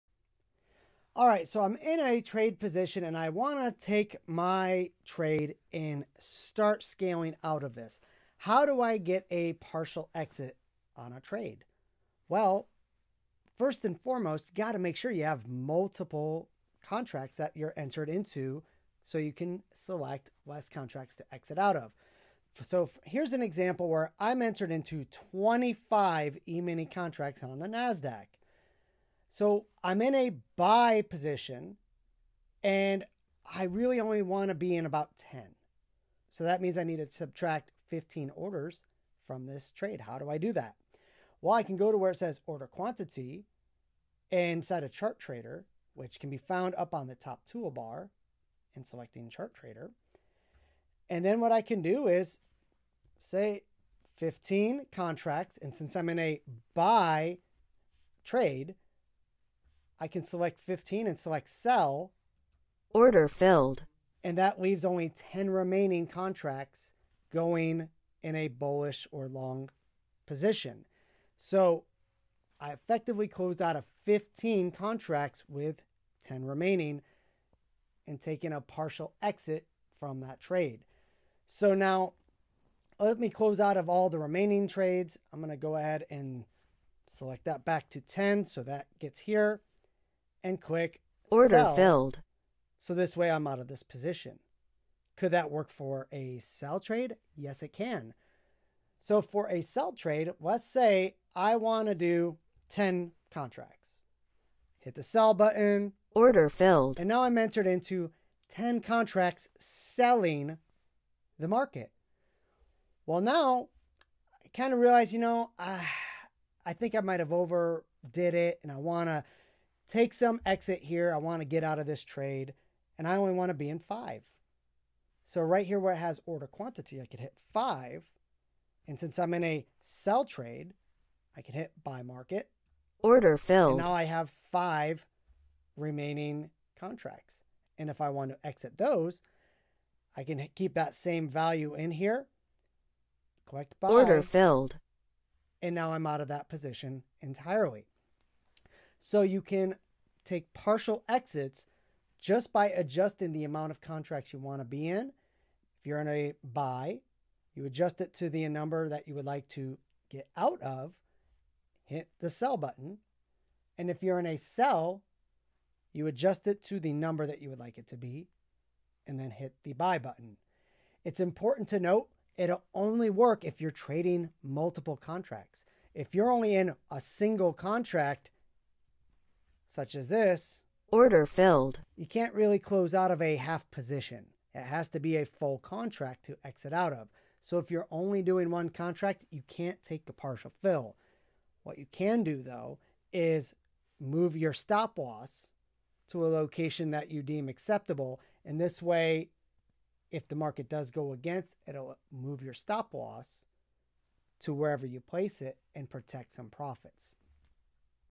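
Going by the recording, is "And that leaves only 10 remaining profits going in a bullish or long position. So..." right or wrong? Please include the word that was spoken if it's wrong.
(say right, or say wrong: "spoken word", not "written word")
wrong: "contracts", not "profits".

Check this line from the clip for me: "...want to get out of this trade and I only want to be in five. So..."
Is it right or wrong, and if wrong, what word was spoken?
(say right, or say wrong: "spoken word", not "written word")
right.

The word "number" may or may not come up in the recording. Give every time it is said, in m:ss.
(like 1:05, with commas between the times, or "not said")
2:38, 2:46.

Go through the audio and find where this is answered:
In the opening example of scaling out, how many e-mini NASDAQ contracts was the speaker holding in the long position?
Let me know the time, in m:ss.
0:25.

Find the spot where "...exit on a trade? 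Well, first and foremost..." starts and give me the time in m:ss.
0:10.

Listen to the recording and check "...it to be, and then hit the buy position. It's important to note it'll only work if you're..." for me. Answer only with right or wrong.
wrong.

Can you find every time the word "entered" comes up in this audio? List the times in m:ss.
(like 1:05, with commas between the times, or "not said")
0:17, 0:24, 1:47.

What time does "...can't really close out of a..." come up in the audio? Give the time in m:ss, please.
3:02.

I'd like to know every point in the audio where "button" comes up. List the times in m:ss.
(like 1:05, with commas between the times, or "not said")
1:45, 2:42, 2:49.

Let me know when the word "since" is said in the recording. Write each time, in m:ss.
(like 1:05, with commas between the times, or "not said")
0:55, 2:08.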